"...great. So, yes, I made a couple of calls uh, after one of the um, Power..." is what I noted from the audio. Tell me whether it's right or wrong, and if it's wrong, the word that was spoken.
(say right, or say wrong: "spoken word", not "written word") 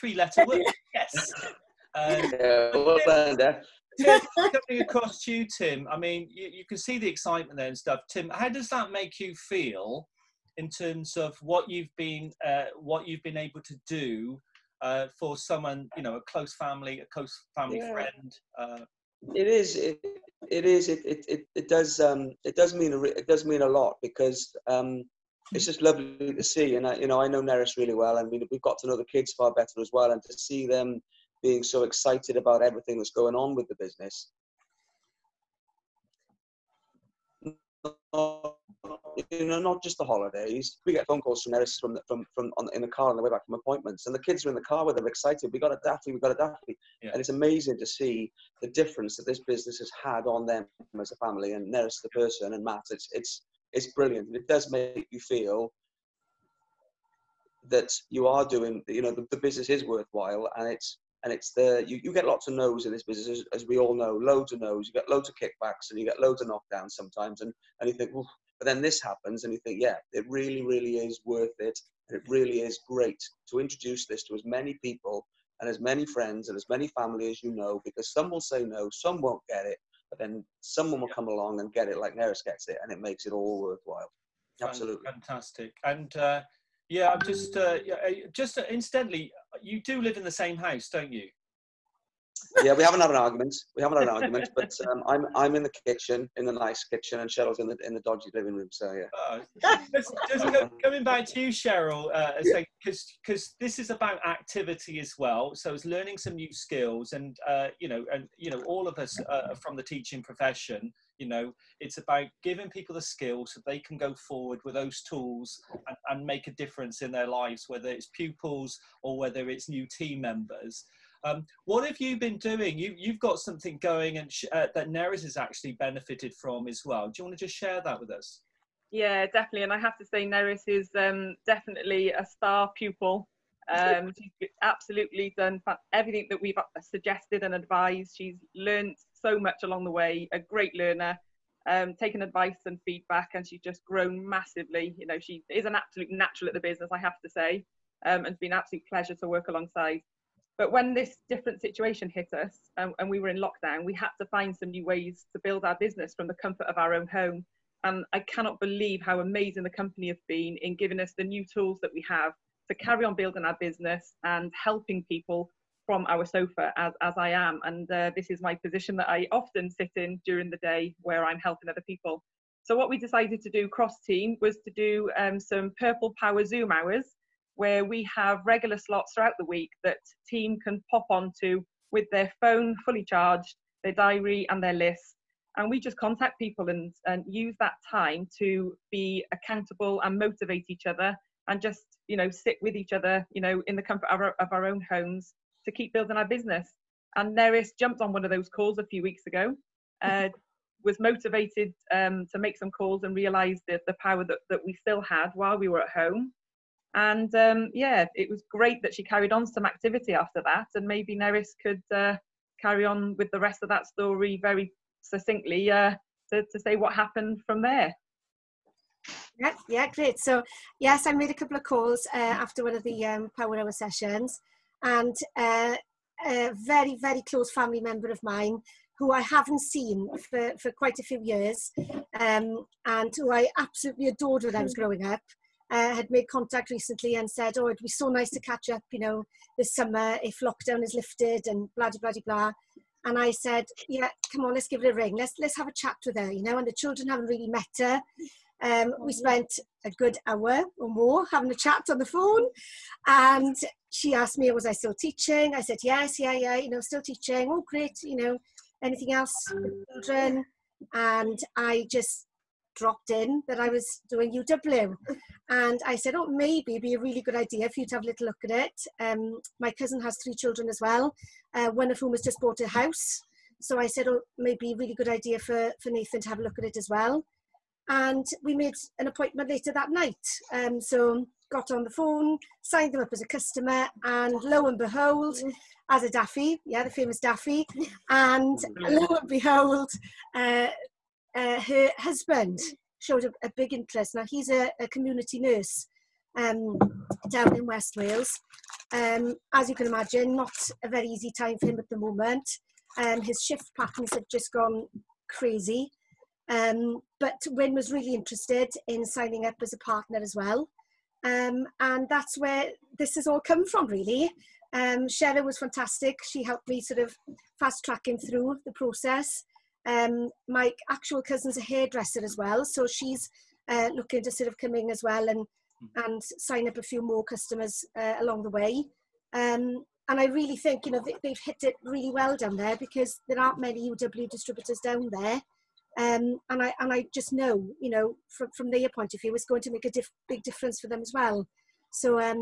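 right.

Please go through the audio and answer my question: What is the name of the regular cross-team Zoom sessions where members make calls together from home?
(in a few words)
Purple Power Zoom hours.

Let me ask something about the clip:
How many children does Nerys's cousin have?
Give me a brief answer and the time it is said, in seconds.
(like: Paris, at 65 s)
3, at 270 s.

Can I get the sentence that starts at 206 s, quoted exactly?
And um, yeah, it was great that she carried on some activity after that.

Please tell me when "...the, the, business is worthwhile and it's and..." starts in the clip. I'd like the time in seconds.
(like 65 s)
59 s.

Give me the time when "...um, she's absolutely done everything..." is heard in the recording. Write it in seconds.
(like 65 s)
133 s.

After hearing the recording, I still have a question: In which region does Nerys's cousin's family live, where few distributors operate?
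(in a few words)
West Wales.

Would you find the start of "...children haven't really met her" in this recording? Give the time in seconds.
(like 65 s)
246 s.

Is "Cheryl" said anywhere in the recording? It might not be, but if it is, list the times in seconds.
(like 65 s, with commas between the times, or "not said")
97 s, 101 s.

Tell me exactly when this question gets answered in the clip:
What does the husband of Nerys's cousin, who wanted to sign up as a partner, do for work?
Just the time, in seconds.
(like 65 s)
294 s.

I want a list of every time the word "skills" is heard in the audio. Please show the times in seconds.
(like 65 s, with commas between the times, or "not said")
106 s, 113 s.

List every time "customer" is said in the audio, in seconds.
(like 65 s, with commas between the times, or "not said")
283 s, 327 s.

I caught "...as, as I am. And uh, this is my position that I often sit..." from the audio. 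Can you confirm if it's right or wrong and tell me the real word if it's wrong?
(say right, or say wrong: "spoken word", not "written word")
right.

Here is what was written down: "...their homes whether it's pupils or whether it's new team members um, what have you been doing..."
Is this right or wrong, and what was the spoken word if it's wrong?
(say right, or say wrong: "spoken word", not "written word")
wrong: "lives", not "homes".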